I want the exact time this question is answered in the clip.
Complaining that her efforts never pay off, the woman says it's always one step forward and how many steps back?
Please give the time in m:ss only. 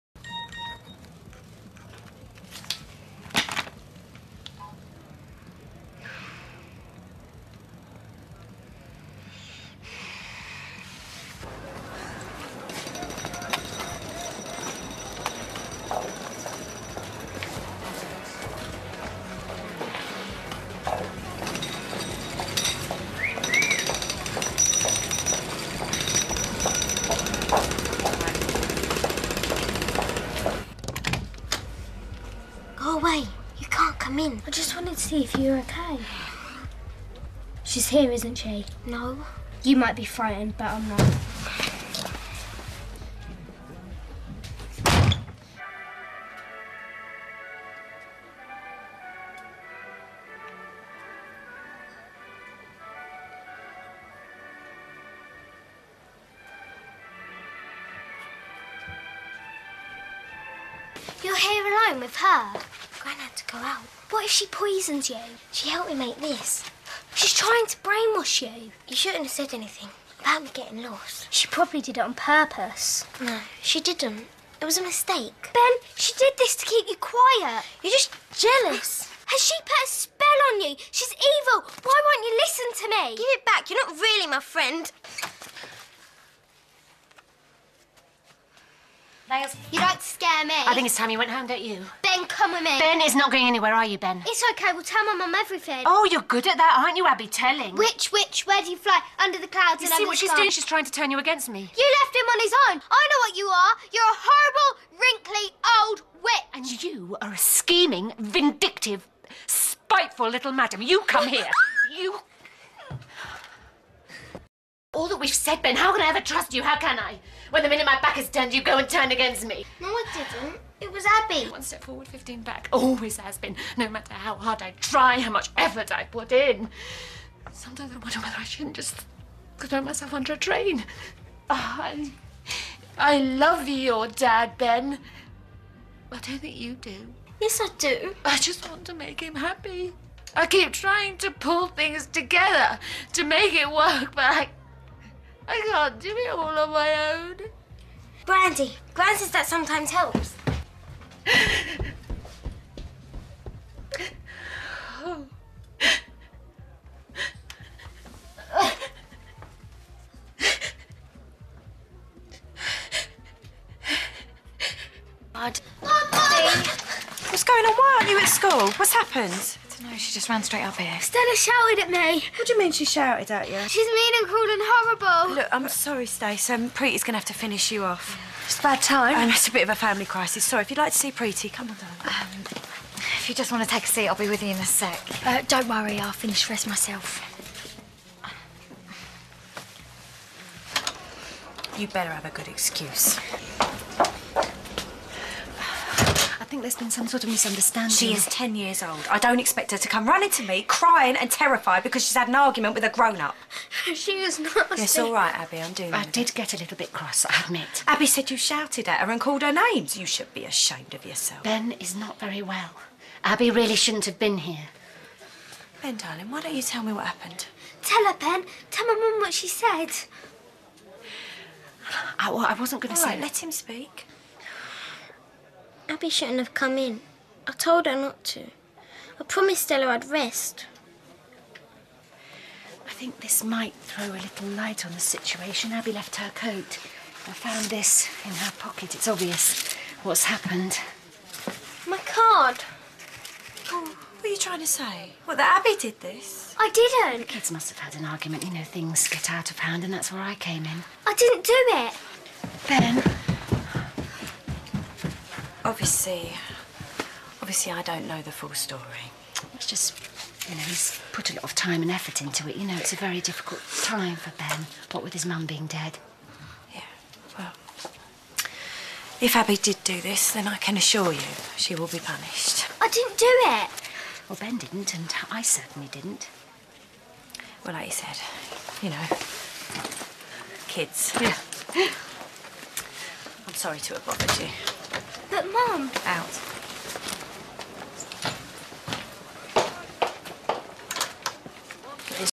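2:02.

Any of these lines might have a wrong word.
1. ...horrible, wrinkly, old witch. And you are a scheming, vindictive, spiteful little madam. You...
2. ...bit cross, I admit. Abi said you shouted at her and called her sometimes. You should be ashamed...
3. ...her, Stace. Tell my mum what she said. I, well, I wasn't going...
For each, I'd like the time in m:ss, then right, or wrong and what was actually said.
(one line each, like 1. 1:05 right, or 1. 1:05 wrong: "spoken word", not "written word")
1. 1:44 right
2. 3:26 wrong: "names", not "sometimes"
3. 3:38 wrong: "Ben", not "Stace".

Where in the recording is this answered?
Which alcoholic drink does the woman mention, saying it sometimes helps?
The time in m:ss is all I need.
2:28.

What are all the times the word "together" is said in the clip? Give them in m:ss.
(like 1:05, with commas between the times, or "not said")
2:22.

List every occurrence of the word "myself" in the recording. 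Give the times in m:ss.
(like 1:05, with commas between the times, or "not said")
2:09, 3:06.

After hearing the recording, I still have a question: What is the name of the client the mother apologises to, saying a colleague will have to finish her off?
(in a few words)
Stace.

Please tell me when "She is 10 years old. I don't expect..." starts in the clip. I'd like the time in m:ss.
3:17.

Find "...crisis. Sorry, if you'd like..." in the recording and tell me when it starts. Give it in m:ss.
3:00.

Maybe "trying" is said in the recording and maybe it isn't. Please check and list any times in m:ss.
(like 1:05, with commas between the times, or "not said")
1:07, 1:40, 2:20, 4:04.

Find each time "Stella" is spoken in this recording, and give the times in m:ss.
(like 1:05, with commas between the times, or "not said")
2:51, 3:49.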